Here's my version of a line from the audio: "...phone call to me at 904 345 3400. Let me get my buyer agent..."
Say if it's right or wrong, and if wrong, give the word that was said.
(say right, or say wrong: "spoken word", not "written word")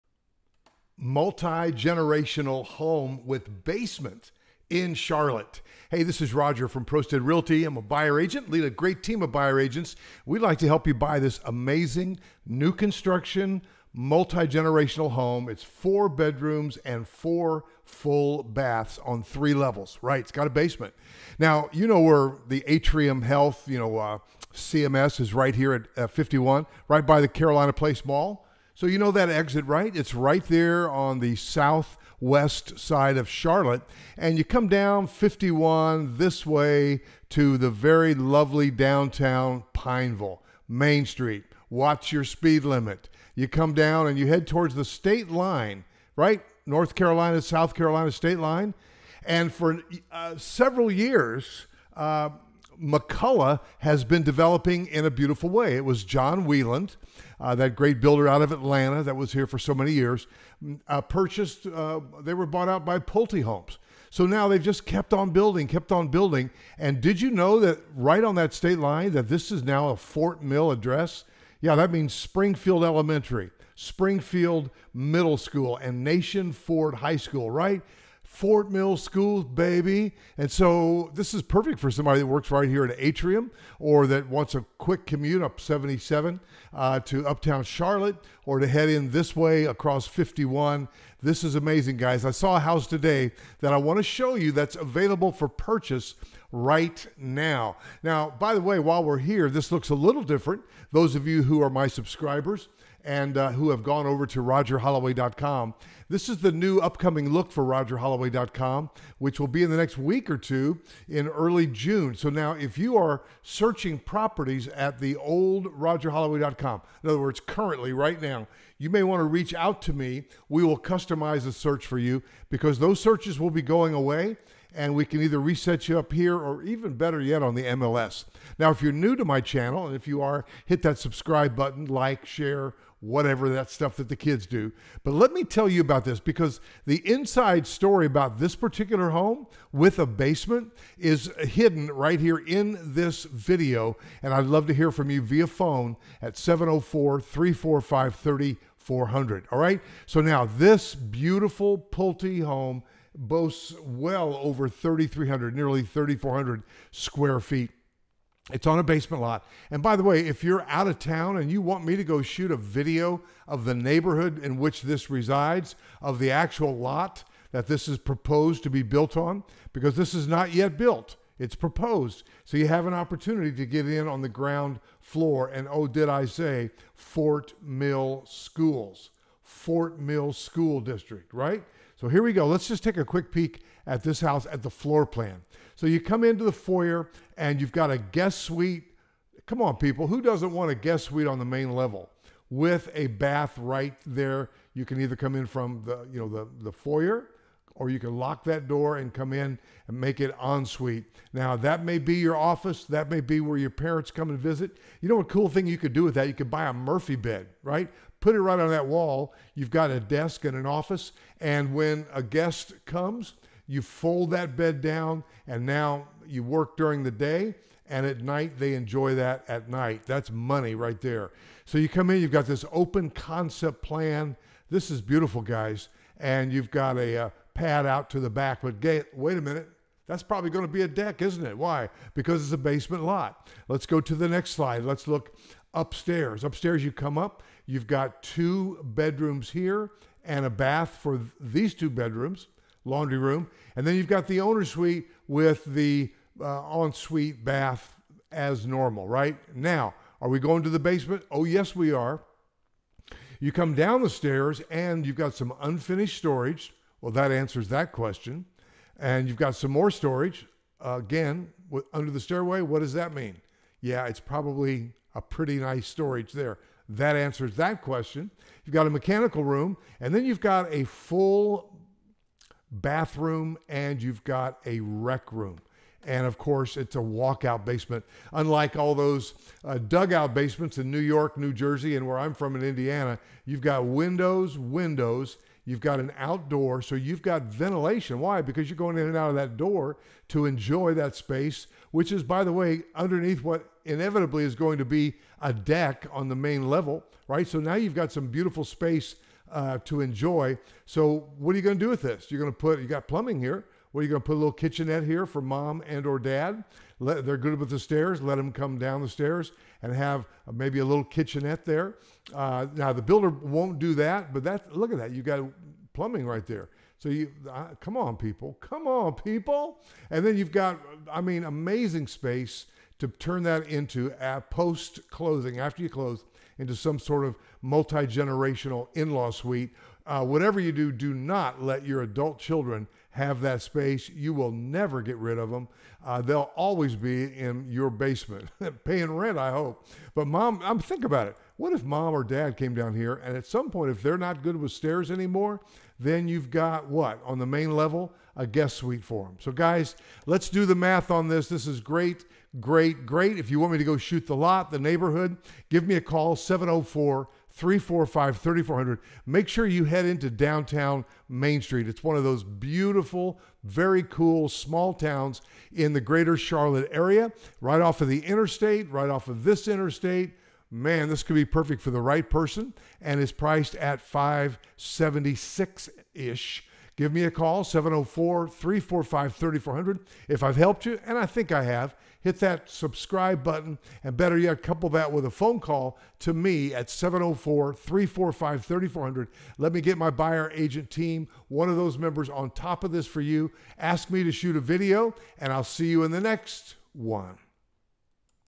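wrong: "704", not "904".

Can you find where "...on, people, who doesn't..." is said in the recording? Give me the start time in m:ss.
3:09.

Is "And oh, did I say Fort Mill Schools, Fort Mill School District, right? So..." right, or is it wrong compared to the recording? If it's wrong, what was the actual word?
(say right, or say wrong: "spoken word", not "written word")
right.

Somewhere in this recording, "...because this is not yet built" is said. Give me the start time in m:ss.
2:49.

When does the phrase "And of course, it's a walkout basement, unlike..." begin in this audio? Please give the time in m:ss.
4:36.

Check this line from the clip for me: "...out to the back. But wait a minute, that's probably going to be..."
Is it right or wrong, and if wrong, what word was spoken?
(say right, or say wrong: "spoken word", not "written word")
right.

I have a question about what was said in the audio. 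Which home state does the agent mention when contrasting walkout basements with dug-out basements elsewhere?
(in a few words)
Indiana.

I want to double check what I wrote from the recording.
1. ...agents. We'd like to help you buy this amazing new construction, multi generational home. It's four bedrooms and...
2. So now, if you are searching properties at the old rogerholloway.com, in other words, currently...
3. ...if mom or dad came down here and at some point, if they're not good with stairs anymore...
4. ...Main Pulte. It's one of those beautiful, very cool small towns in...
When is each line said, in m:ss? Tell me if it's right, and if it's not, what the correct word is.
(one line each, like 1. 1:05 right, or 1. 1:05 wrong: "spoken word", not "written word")
1. 0:09 right
2. 1:52 right
3. 5:41 right
4. 6:01 wrong: "Street", not "Pulte".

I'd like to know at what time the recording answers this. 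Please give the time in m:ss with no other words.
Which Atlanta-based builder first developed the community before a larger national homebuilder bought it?
0:56.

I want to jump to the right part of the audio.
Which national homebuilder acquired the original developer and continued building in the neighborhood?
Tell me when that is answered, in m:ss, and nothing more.
1:02.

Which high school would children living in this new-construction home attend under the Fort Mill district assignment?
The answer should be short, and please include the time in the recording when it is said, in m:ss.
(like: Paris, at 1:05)
Nation Ford High School, at 1:16.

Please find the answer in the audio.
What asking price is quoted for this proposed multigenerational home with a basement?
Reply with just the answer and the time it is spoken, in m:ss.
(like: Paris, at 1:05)
576, at 6:13.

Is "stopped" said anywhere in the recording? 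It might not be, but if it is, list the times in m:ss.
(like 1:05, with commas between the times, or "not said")
not said.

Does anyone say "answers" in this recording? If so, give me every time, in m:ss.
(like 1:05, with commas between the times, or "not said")
4:17, 4:27.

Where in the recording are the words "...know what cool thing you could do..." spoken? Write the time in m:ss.
3:25.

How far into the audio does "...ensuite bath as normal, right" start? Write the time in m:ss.
4:06.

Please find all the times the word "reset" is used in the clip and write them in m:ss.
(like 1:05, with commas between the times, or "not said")
2:05.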